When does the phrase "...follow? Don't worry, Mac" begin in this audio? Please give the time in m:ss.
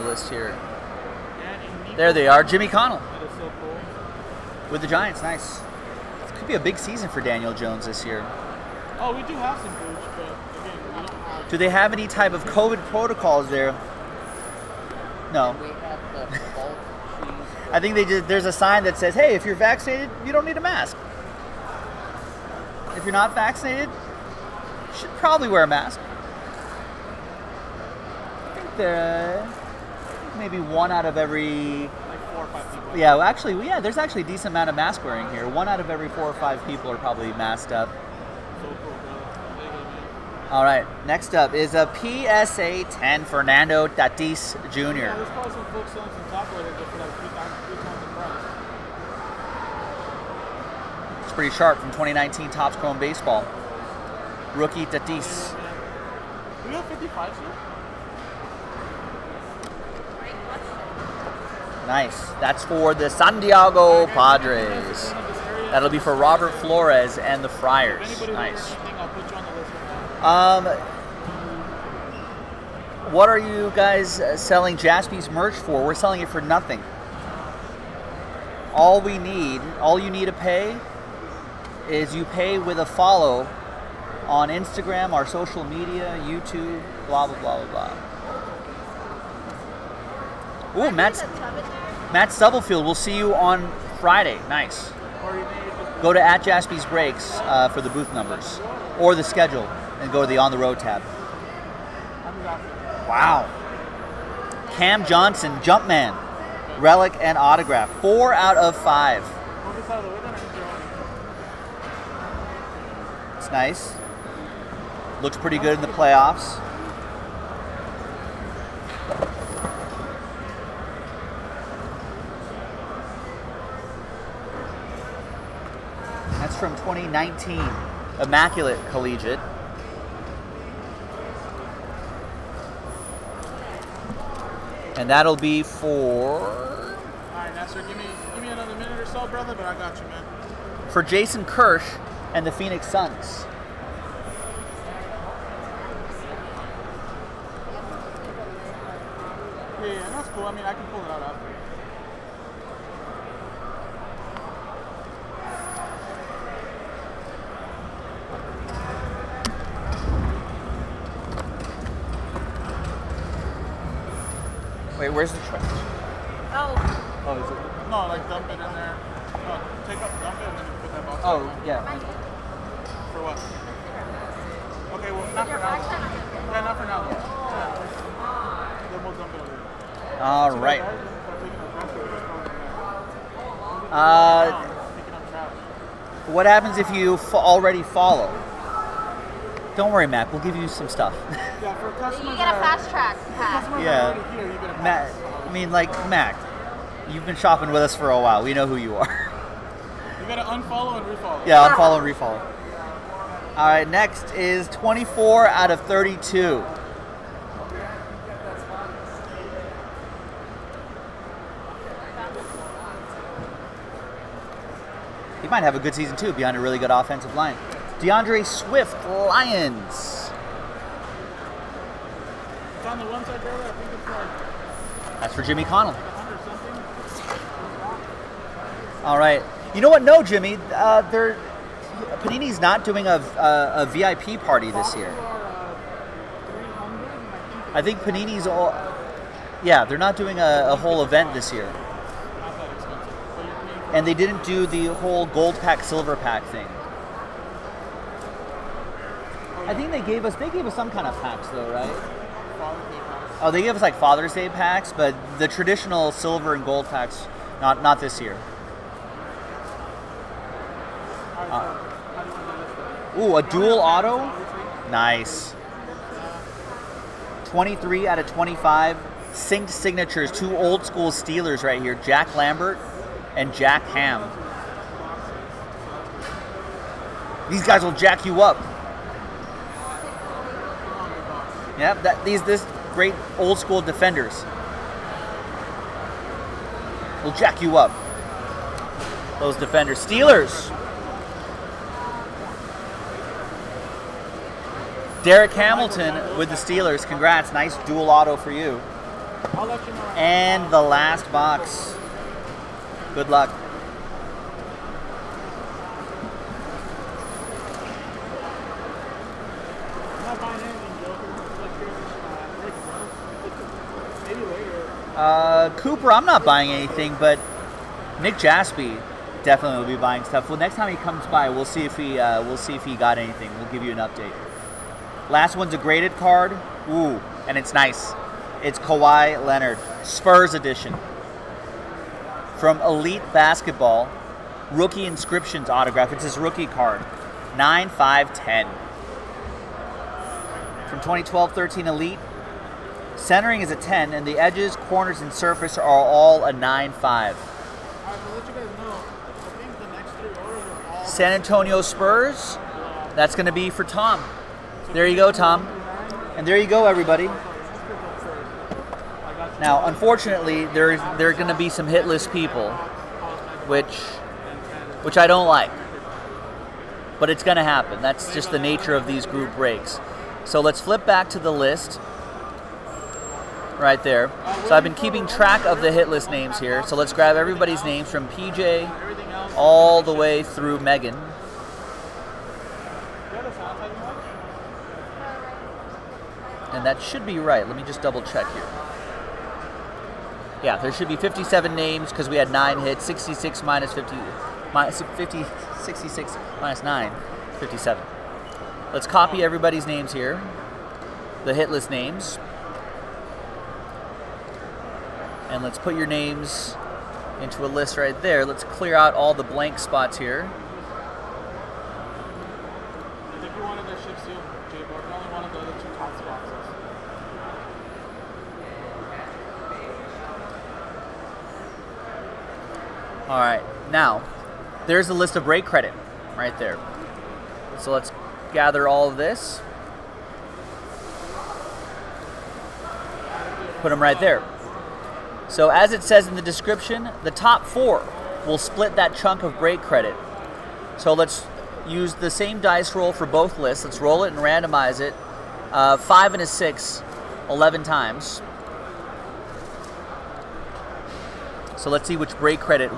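3:07.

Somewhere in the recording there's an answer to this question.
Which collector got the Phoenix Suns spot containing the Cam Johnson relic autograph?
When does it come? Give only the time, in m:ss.
2:21.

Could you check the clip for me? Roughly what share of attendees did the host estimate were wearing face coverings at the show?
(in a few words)
1 in 4 or 5.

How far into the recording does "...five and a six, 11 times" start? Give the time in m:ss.
7:25.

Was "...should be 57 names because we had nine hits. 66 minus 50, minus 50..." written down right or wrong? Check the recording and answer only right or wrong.
right.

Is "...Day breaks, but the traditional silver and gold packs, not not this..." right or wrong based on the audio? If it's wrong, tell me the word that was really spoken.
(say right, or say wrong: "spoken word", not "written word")
wrong: "packs", not "breaks".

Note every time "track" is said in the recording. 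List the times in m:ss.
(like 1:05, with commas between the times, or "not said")
3:12, 6:15.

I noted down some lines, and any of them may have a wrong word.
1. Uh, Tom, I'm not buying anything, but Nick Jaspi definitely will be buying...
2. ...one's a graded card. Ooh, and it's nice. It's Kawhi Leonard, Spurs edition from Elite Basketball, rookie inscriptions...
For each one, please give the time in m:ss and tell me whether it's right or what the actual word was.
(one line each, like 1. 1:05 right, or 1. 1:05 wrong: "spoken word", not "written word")
1. 5:15 wrong: "Cooper", not "Tom"
2. 5:25 right.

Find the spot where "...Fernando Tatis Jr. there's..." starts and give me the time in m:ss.
0:43.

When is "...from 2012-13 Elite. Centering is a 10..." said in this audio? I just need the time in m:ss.
5:40.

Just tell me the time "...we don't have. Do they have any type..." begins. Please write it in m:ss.
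0:10.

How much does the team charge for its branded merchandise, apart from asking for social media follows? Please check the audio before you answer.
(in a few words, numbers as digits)
Nothing.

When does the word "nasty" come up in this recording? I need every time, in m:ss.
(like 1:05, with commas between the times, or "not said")
not said.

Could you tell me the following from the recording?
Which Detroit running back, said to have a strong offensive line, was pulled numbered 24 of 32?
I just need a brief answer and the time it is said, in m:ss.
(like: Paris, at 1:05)
DeAndre Swift, at 3:37.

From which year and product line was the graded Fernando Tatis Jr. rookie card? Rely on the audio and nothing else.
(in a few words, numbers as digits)
2019 Topps Chrome.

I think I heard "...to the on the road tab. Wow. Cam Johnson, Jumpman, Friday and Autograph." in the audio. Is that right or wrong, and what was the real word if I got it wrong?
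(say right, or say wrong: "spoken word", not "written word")
wrong: "Relic", not "Friday".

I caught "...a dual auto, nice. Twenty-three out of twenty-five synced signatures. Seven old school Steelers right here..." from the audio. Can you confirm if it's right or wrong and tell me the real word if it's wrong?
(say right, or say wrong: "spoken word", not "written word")
wrong: "Two", not "Seven".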